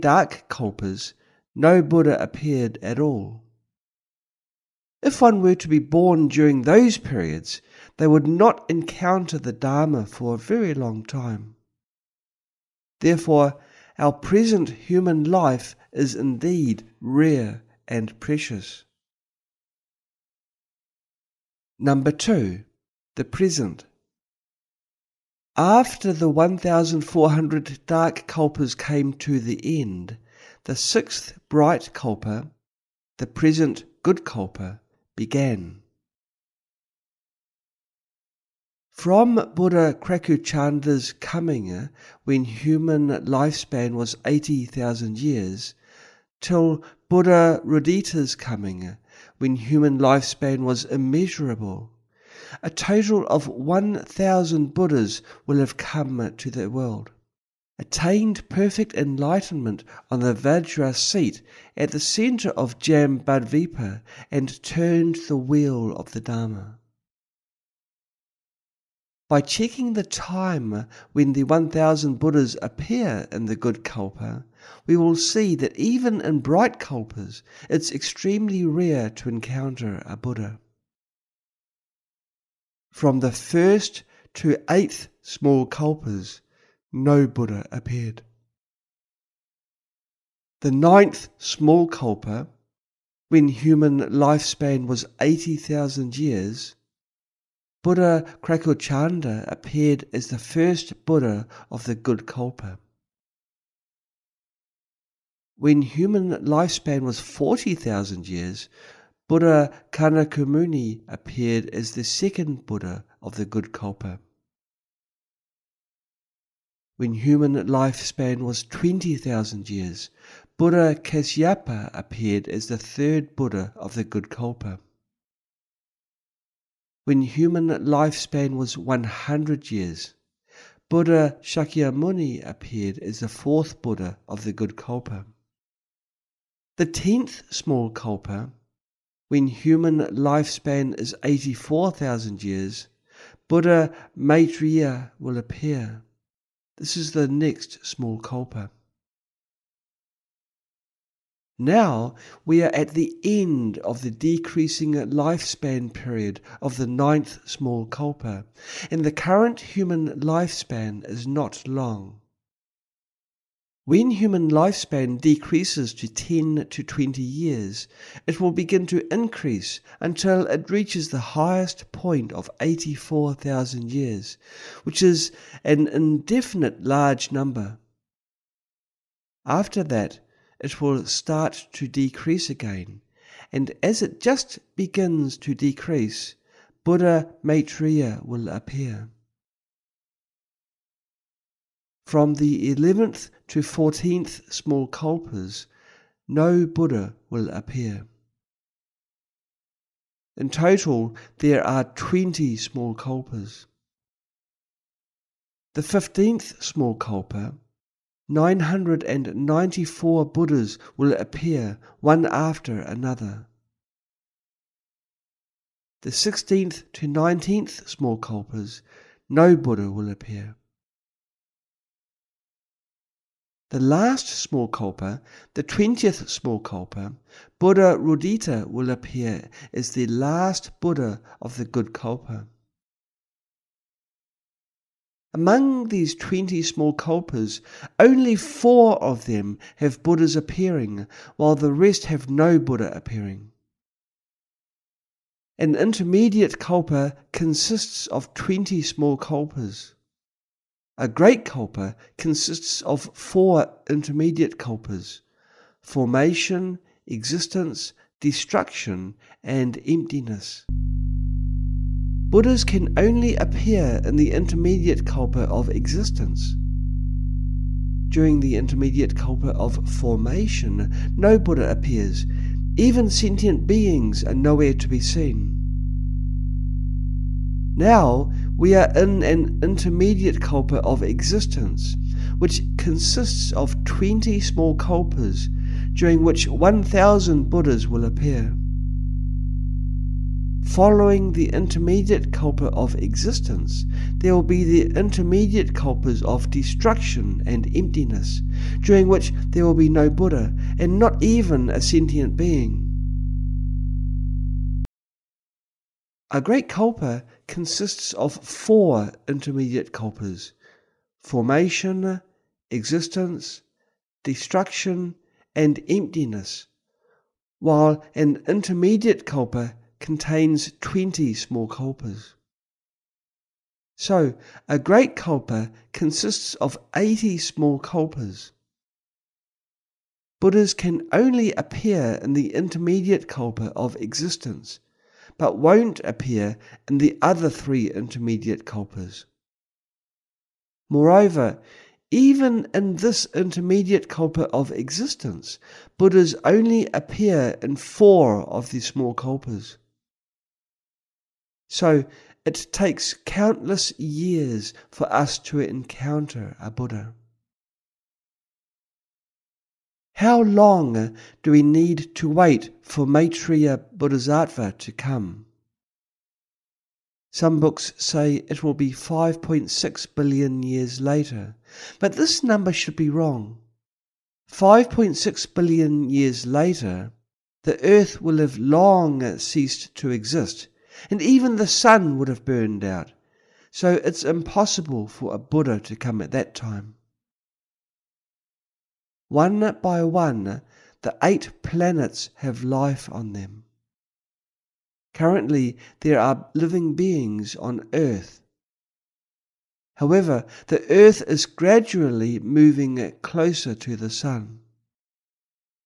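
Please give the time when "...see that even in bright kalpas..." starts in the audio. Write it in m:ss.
1:15.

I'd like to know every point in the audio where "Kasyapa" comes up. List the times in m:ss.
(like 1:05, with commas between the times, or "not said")
2:00.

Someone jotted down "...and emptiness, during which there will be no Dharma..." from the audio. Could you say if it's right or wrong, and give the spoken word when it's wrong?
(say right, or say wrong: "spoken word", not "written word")
wrong: "Buddha", not "Dharma".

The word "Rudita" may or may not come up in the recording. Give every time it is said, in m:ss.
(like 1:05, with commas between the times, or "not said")
0:47, 3:47.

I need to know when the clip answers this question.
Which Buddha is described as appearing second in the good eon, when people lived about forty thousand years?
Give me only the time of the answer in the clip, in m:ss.
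1:49.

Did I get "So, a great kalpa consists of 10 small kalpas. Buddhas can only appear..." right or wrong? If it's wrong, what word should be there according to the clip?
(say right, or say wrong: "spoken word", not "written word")
wrong: "80", not "10".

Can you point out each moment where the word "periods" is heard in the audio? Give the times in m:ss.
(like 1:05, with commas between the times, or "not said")
0:06, 2:35.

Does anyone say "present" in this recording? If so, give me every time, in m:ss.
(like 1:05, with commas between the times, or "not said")
0:14, 0:23, 0:33.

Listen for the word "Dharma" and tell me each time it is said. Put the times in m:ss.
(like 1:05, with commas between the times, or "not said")
0:09, 1:06.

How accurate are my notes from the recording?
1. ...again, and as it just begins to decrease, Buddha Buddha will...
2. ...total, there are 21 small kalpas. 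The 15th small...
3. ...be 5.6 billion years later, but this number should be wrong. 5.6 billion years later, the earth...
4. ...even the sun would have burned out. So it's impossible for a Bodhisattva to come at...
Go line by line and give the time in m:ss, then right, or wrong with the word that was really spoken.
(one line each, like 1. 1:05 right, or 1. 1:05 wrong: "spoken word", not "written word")
1. 3:02 wrong: "Maitreya", not "Buddha"
2. 3:20 wrong: "20", not "21"
3. 6:08 right
4. 6:21 wrong: "Buddha", not "Bodhisattva".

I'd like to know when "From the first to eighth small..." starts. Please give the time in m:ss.
1:22.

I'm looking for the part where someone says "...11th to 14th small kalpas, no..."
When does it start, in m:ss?
3:12.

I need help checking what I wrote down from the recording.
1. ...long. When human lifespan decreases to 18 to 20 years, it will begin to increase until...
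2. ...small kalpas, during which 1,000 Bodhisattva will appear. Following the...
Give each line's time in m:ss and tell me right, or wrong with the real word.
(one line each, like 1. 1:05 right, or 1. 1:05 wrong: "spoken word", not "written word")
1. 2:41 wrong: "10", not "18"
2. 4:44 wrong: "Buddhas", not "Bodhisattva".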